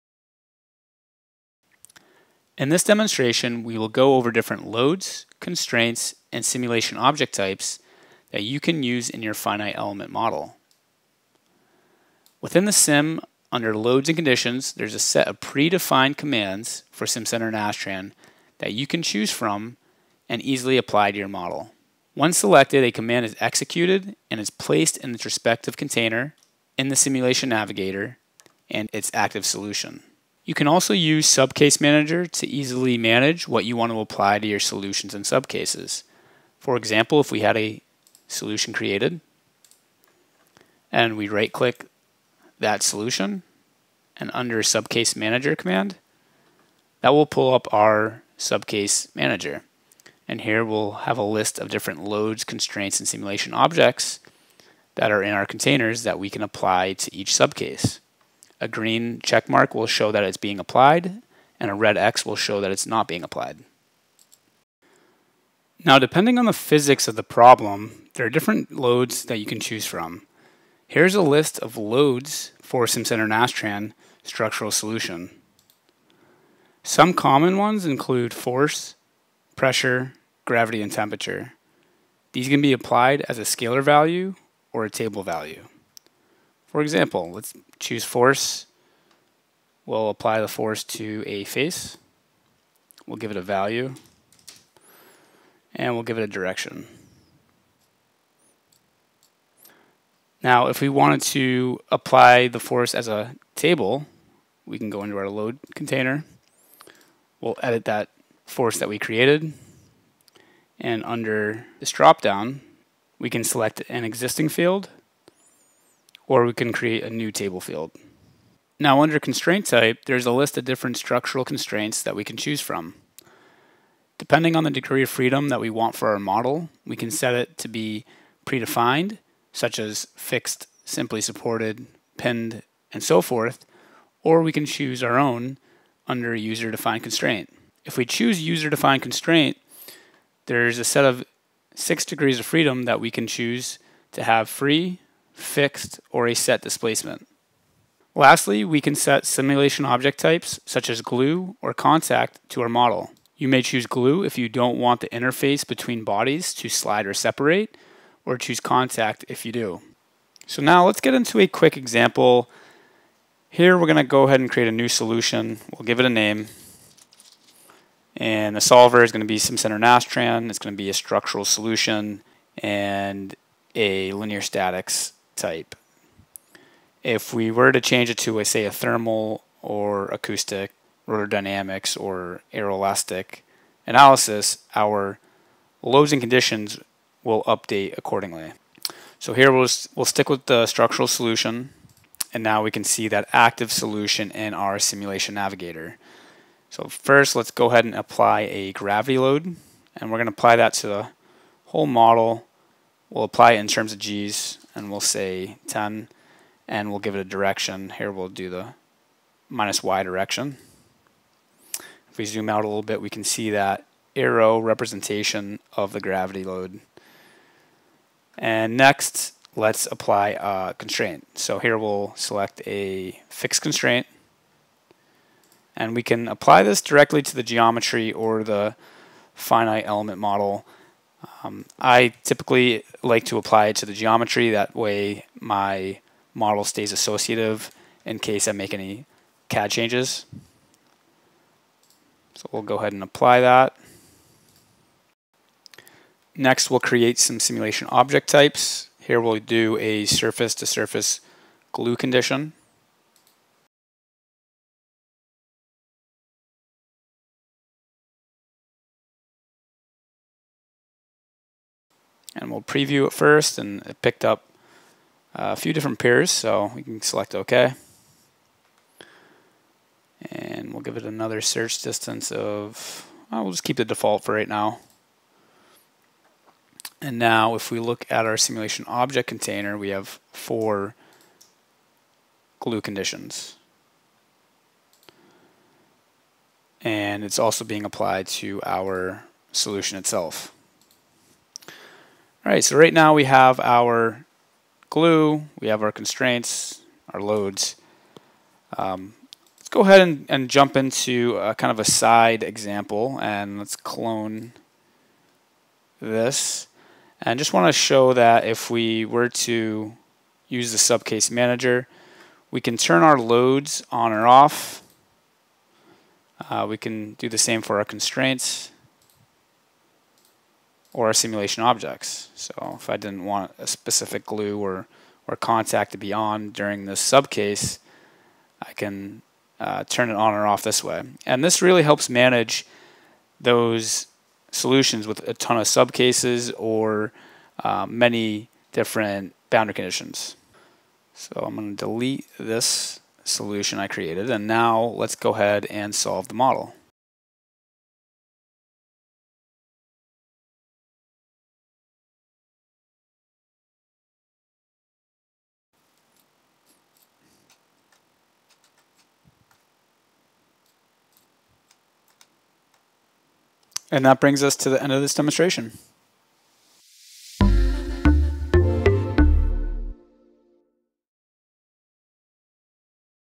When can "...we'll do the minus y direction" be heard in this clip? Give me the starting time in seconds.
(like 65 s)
208 s.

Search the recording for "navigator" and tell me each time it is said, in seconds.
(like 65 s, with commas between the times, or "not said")
27 s, 195 s.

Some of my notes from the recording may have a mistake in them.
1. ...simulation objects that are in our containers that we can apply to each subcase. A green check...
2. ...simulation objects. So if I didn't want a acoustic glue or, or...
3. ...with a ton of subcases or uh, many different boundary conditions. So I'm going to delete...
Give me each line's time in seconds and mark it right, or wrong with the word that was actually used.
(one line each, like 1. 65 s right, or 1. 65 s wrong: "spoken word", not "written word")
1. 53 s right
2. 321 s wrong: "specific", not "acoustic"
3. 335 s right.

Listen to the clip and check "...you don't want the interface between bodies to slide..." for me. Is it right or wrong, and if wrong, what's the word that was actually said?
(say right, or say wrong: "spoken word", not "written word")
right.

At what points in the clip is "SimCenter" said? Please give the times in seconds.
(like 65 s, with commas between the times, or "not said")
17 s, 72 s, 169 s.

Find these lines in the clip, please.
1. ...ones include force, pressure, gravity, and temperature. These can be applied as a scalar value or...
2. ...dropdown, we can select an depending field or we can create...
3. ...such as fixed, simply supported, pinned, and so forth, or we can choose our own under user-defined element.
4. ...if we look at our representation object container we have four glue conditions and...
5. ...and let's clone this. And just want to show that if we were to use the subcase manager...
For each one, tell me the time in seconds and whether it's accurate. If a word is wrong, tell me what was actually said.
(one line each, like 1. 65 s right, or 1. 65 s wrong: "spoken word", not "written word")
1. 77 s right
2. 111 s wrong: "existing", not "depending"
3. 129 s wrong: "constraint", not "element"
4. 277 s wrong: "simulation", not "representation"
5. 303 s right.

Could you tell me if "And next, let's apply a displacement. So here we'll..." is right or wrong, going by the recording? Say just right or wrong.
wrong.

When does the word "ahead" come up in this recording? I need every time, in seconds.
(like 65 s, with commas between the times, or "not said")
164 s, 197 s, 242 s, 299 s, 345 s.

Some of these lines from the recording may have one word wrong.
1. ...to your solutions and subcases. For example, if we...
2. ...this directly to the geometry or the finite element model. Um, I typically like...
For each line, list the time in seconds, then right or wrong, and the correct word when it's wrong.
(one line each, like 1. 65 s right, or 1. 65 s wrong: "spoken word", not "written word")
1. 34 s right
2. 226 s right.